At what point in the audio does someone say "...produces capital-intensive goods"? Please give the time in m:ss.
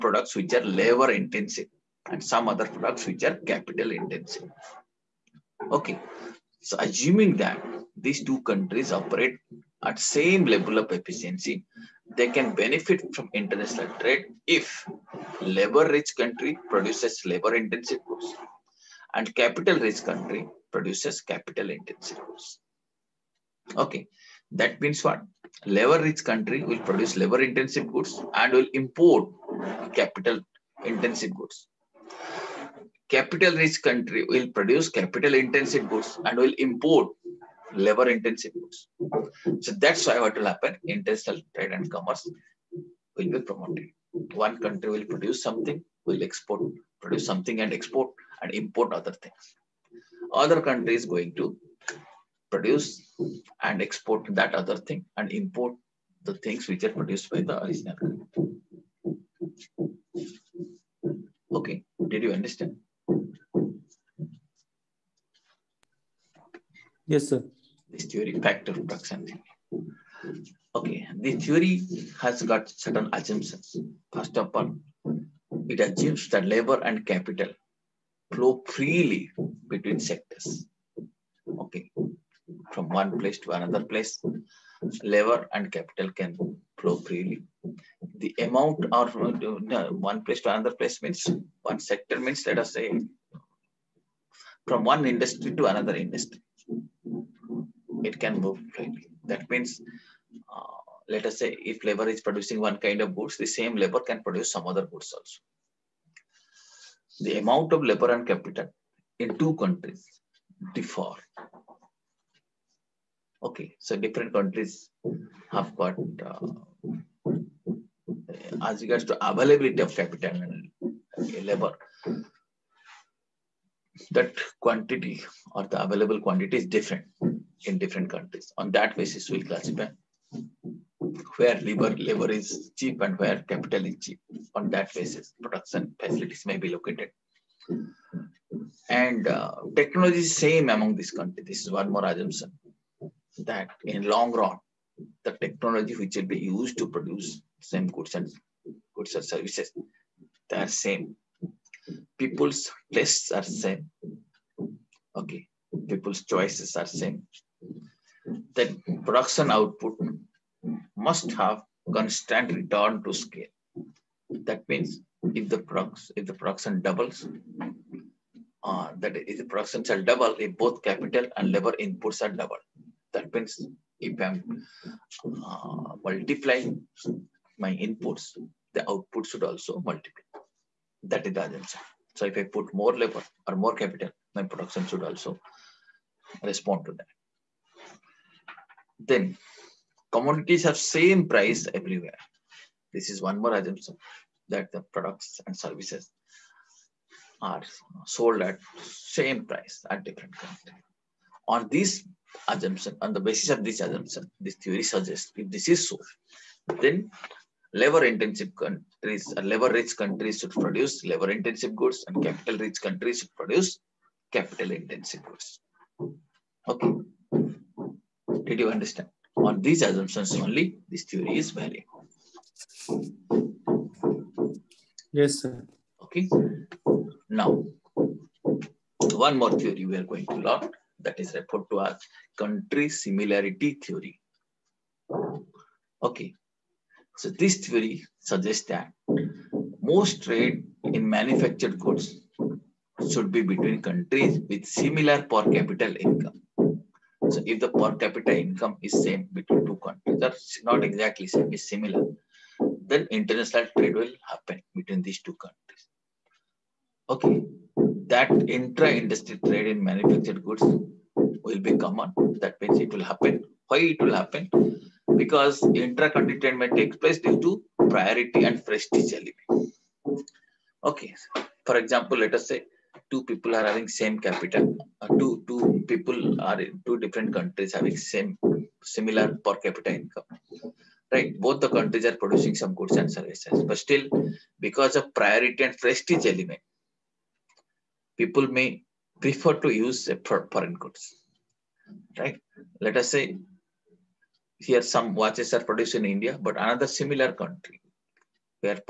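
0:20.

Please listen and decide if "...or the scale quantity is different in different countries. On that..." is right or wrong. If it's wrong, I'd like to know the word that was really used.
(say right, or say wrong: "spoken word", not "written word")
wrong: "available", not "scale".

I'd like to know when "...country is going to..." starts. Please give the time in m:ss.
0:50.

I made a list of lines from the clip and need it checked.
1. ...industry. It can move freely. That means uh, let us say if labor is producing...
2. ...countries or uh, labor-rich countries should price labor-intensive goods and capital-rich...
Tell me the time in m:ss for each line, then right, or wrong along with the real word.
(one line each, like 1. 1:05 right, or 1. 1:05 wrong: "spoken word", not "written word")
1. 1:35 right
2. 3:28 wrong: "produce", not "price".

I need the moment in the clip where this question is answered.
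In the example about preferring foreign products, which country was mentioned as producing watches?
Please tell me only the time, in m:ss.
4:56.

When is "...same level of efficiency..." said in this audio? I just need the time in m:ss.
0:09.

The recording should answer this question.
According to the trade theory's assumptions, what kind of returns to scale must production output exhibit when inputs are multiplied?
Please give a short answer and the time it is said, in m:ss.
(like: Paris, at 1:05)
Constant return to scale, at 2:41.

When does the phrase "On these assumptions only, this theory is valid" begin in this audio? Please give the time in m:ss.
3:39.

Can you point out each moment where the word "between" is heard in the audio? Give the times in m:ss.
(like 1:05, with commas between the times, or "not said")
1:19, 4:03, 4:09, 4:14.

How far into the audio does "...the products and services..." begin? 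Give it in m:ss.
3:14.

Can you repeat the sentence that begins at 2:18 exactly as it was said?
And uh, technology is same among these countries.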